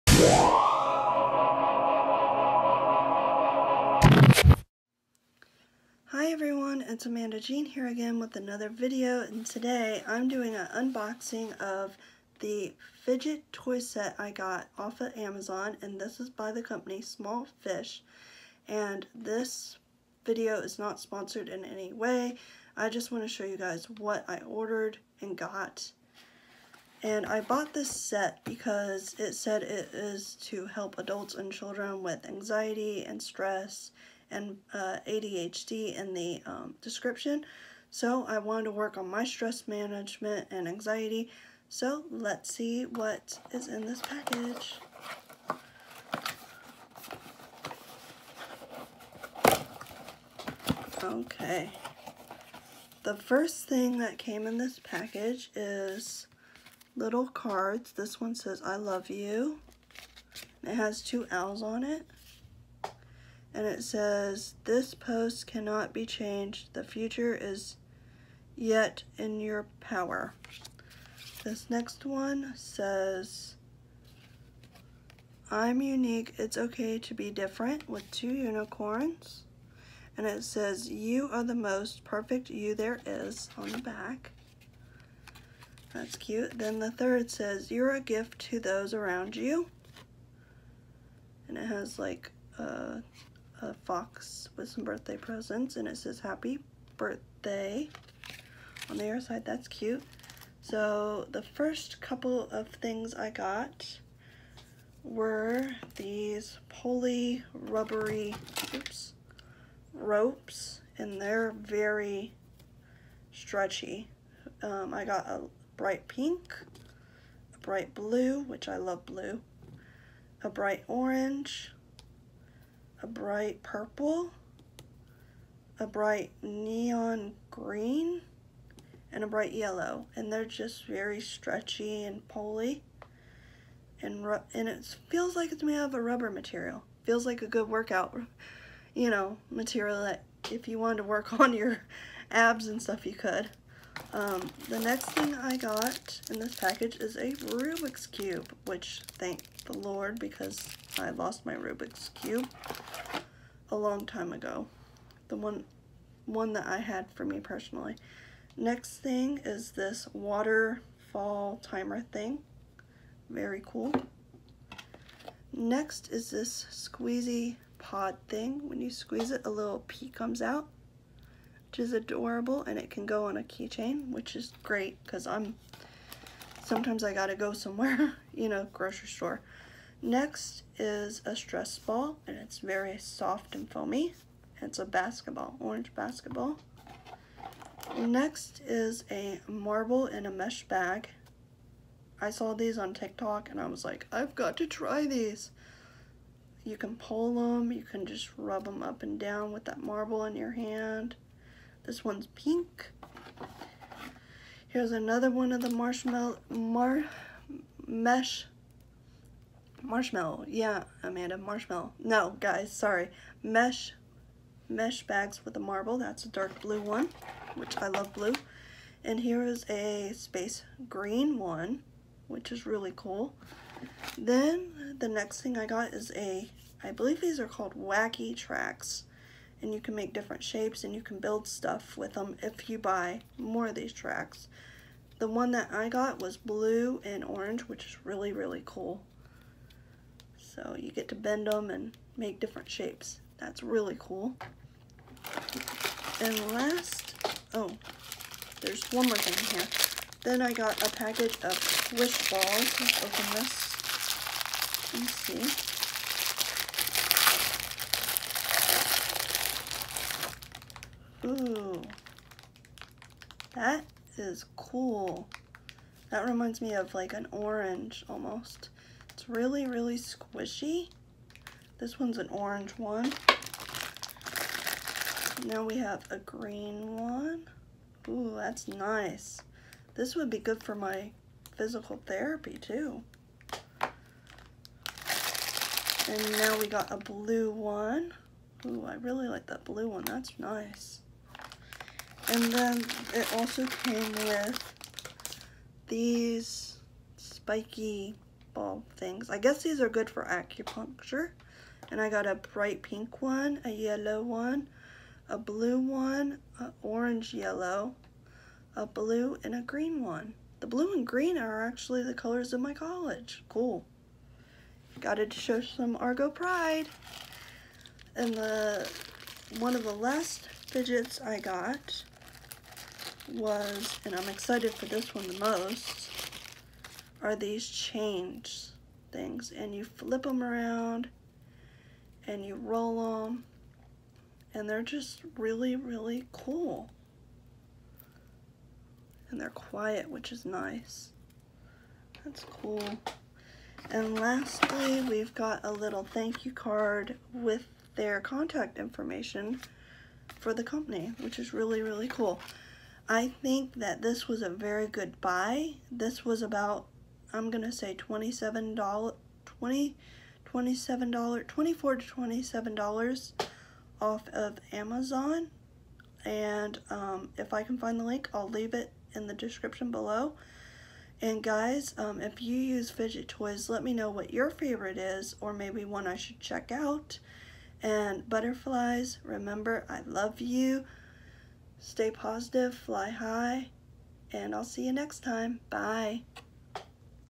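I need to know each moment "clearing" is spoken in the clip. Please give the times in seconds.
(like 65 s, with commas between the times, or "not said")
not said.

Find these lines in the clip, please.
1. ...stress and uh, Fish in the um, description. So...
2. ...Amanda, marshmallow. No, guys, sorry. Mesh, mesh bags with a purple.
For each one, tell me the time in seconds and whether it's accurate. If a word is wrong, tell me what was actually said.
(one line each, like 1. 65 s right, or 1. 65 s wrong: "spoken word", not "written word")
1. 33 s wrong: "ADHD", not "Fish"
2. 211 s wrong: "marble", not "purple".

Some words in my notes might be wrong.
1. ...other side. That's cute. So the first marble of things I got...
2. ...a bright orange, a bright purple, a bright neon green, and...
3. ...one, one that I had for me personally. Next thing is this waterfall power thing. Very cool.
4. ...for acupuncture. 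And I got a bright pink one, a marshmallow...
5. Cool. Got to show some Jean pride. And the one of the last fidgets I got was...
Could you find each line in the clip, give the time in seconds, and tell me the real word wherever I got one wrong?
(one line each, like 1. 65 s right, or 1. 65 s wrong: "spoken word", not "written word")
1. 99 s wrong: "couple", not "marble"
2. 120 s right
3. 155 s wrong: "timer", not "power"
4. 300 s wrong: "yellow", not "marshmallow"
5. 313 s wrong: "Argo", not "Jean".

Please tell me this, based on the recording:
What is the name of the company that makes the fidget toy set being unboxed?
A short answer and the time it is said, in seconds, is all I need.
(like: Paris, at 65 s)
Small Fish, at 17 s.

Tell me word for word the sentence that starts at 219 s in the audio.
And here is a space green one, which is really cool.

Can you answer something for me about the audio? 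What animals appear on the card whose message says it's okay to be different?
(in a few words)
unicorns.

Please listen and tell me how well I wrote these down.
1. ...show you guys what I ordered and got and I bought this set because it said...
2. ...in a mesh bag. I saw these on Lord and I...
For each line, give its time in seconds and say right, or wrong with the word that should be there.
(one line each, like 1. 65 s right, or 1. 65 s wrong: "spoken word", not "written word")
1. 23 s right
2. 190 s wrong: "TikTok", not "Lord".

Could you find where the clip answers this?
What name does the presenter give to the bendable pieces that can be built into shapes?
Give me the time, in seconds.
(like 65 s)
227 s.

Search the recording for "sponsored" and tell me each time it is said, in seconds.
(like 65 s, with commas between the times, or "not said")
20 s.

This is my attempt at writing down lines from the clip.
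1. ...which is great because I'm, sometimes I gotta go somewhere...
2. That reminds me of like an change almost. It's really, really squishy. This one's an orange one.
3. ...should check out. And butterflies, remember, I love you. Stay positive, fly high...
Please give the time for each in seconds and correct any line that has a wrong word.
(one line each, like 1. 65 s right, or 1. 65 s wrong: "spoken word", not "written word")
1. 174 s right
2. 266 s wrong: "orange", not "change"
3. 376 s right.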